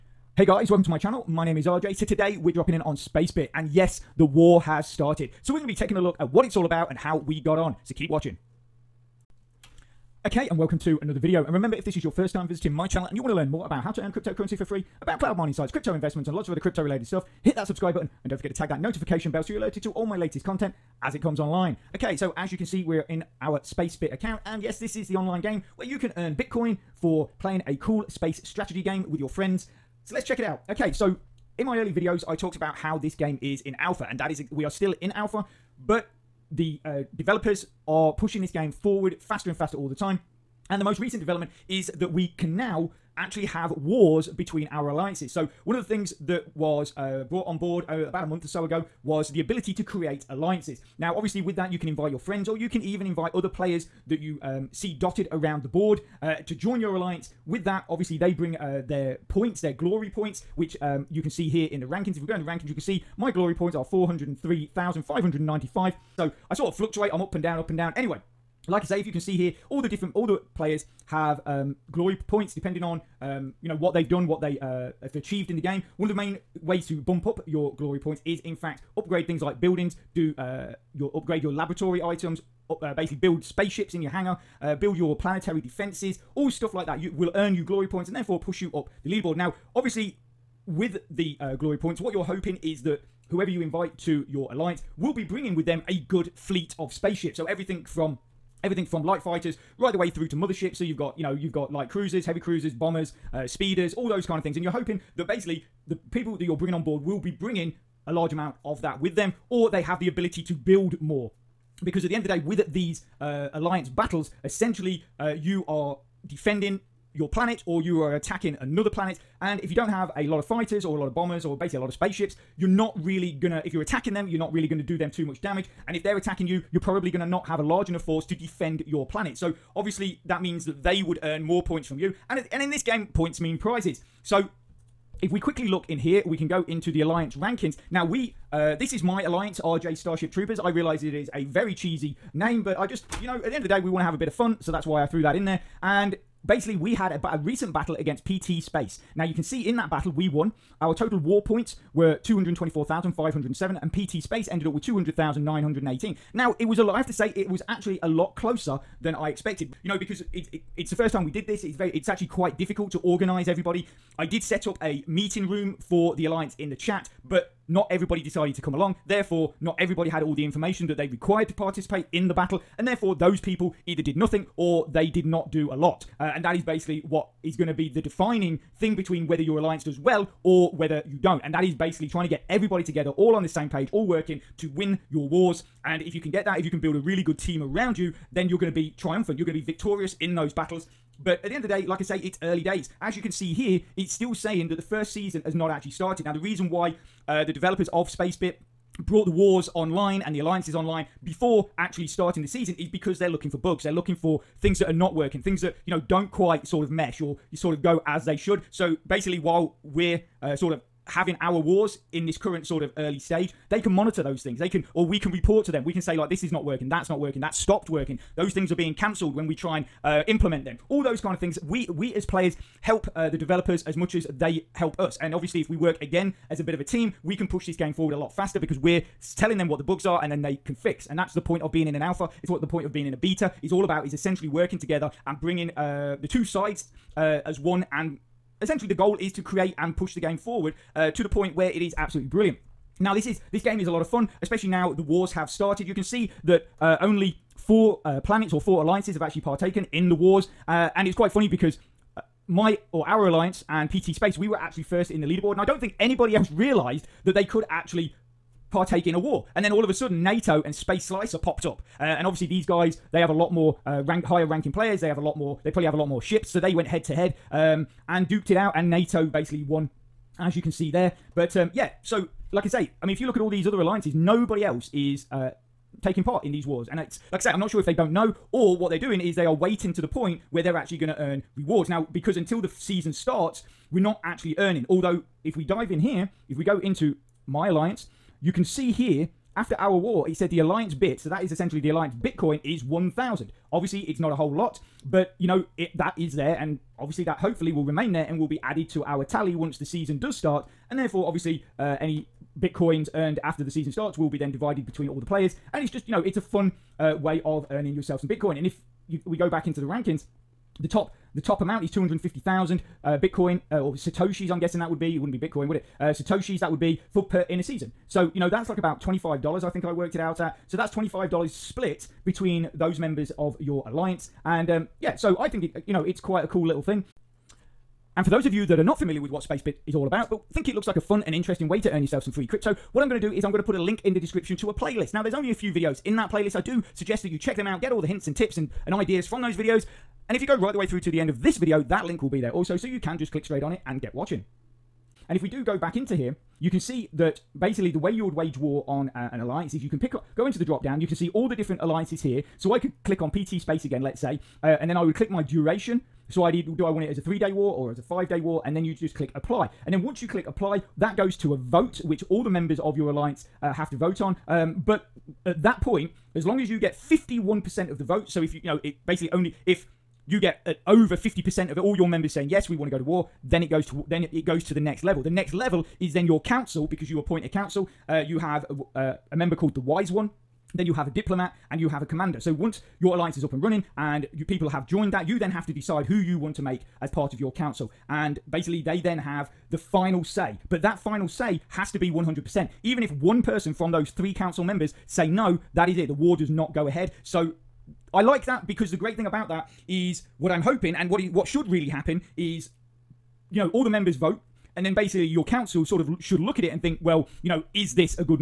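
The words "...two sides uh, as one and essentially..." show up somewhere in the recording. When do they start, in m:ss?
3:56.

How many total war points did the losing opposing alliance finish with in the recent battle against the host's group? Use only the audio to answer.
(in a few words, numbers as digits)
200,918.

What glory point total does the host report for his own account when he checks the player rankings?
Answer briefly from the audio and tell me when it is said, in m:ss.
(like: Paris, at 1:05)
403,595, at 1:03.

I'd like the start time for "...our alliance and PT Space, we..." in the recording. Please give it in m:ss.
4:13.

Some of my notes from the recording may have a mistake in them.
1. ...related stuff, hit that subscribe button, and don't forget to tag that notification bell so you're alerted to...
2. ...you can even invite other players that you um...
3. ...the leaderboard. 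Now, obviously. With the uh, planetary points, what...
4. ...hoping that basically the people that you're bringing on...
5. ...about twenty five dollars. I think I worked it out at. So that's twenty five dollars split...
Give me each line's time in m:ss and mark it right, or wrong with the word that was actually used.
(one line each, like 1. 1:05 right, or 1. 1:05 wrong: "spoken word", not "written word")
1. 0:16 right
2. 0:52 right
3. 1:29 wrong: "glory", not "planetary"
4. 1:44 right
5. 5:18 right.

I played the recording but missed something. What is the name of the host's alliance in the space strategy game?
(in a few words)
RJ Starship Troopers.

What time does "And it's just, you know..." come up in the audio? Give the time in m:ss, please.
5:05.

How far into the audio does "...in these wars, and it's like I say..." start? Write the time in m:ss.
4:36.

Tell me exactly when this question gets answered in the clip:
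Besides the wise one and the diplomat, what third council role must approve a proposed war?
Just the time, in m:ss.
6:22.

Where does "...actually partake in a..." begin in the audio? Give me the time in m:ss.
4:17.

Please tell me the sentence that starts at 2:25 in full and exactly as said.
And basically, we had a, a recent battle against PT Space.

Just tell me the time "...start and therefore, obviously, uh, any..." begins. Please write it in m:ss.
5:00.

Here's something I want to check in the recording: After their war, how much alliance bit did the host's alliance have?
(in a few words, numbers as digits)
1,000.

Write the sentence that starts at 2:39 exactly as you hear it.
You know, because it, it it's the first time we did this.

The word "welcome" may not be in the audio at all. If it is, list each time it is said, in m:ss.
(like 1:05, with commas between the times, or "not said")
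0:00, 0:10.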